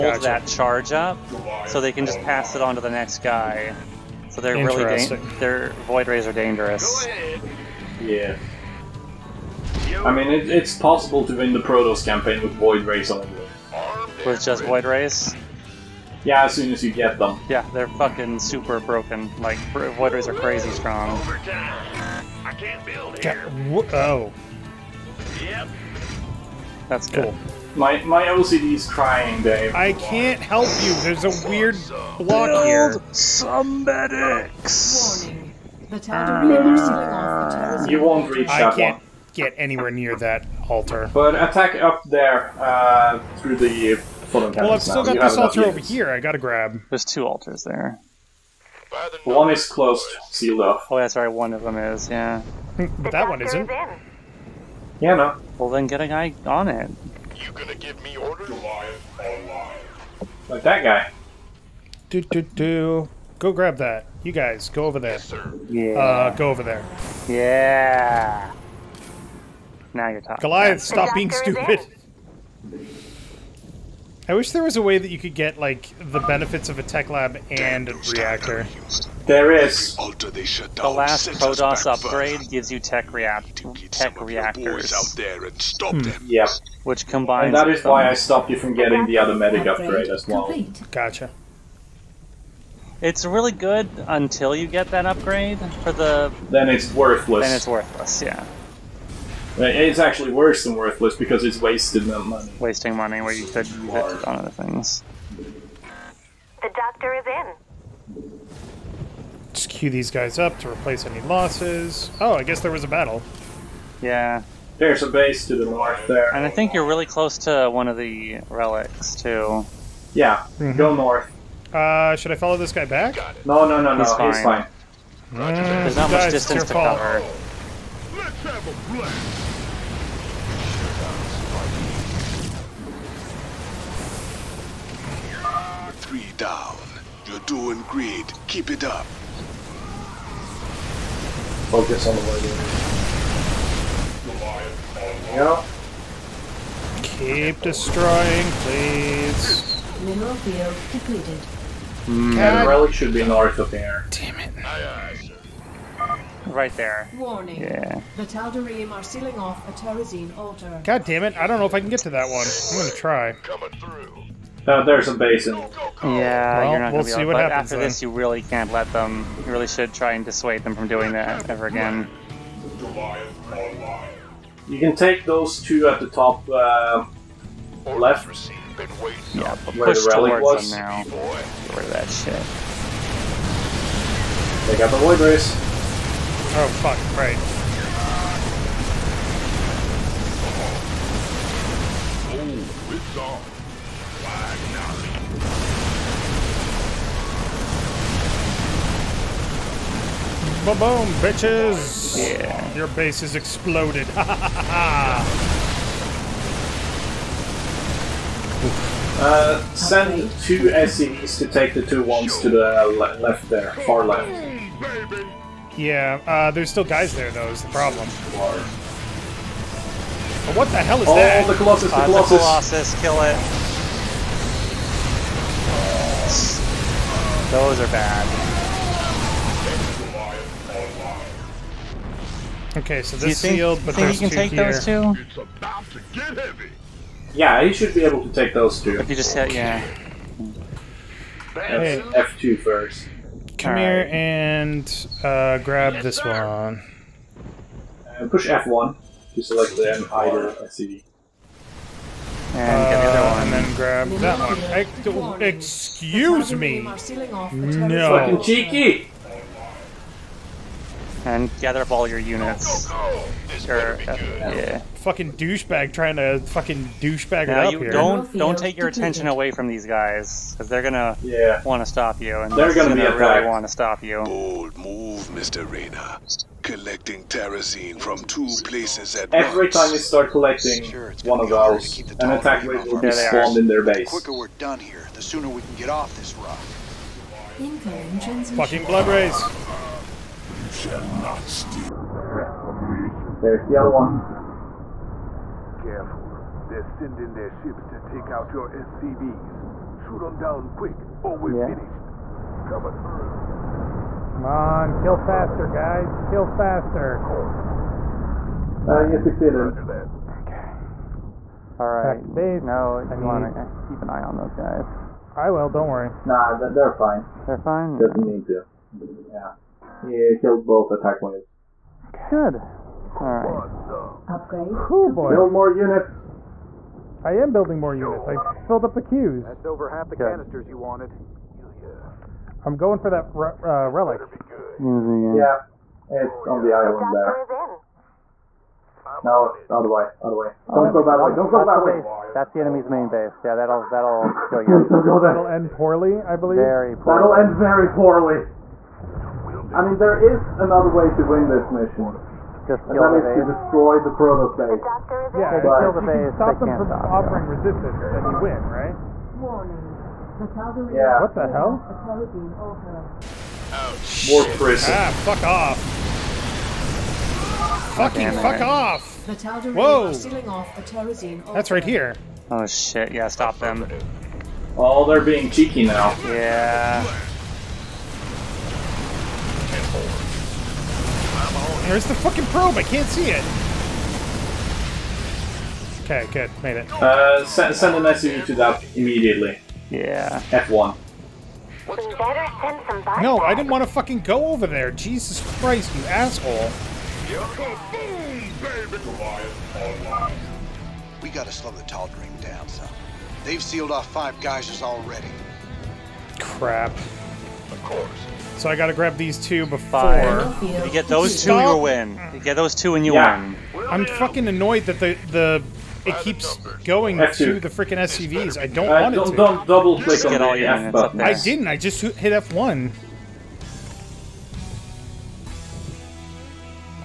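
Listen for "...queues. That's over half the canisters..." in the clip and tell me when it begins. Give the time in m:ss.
5:29.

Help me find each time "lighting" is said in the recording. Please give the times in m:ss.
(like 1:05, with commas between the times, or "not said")
2:25.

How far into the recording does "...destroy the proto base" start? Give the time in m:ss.
5:53.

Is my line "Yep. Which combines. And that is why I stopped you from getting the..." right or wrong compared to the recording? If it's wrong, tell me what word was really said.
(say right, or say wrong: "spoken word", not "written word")
right.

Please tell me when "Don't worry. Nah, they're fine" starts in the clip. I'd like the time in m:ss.
5:15.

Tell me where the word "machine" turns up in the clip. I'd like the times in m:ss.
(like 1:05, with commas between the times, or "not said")
not said.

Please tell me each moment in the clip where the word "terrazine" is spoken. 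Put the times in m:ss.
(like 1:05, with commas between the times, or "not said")
2:39, 4:37.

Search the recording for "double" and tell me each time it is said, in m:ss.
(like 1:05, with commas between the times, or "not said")
6:59.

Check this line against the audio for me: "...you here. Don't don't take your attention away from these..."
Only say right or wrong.
right.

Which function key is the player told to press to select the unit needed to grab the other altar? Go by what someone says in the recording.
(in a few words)
F1.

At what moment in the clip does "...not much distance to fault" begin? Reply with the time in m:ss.
2:05.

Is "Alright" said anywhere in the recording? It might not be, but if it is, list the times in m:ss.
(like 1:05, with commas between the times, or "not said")
5:23.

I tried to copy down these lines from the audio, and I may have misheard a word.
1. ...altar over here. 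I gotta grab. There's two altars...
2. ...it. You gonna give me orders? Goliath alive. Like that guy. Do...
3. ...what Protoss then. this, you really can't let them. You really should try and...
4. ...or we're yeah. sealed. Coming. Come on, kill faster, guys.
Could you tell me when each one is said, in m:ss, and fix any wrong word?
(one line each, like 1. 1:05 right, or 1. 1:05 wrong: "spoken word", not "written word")
1. 0:45 right
2. 0:56 right
3. 2:47 wrong: "After", not "Protoss"
4. 5:01 wrong: "finished", not "sealed".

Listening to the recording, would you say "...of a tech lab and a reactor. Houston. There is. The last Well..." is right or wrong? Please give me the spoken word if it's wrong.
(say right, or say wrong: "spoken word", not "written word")
wrong: "Protoss", not "Well".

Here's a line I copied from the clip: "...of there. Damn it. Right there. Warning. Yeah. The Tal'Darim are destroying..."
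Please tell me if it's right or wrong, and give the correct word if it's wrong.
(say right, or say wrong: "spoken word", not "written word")
wrong: "sealing", not "destroying".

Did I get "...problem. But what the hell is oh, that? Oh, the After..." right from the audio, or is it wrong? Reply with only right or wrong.
wrong.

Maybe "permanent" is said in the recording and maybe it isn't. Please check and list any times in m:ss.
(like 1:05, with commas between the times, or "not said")
not said.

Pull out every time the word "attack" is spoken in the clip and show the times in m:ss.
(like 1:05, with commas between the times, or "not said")
0:41, 4:42, 5:20.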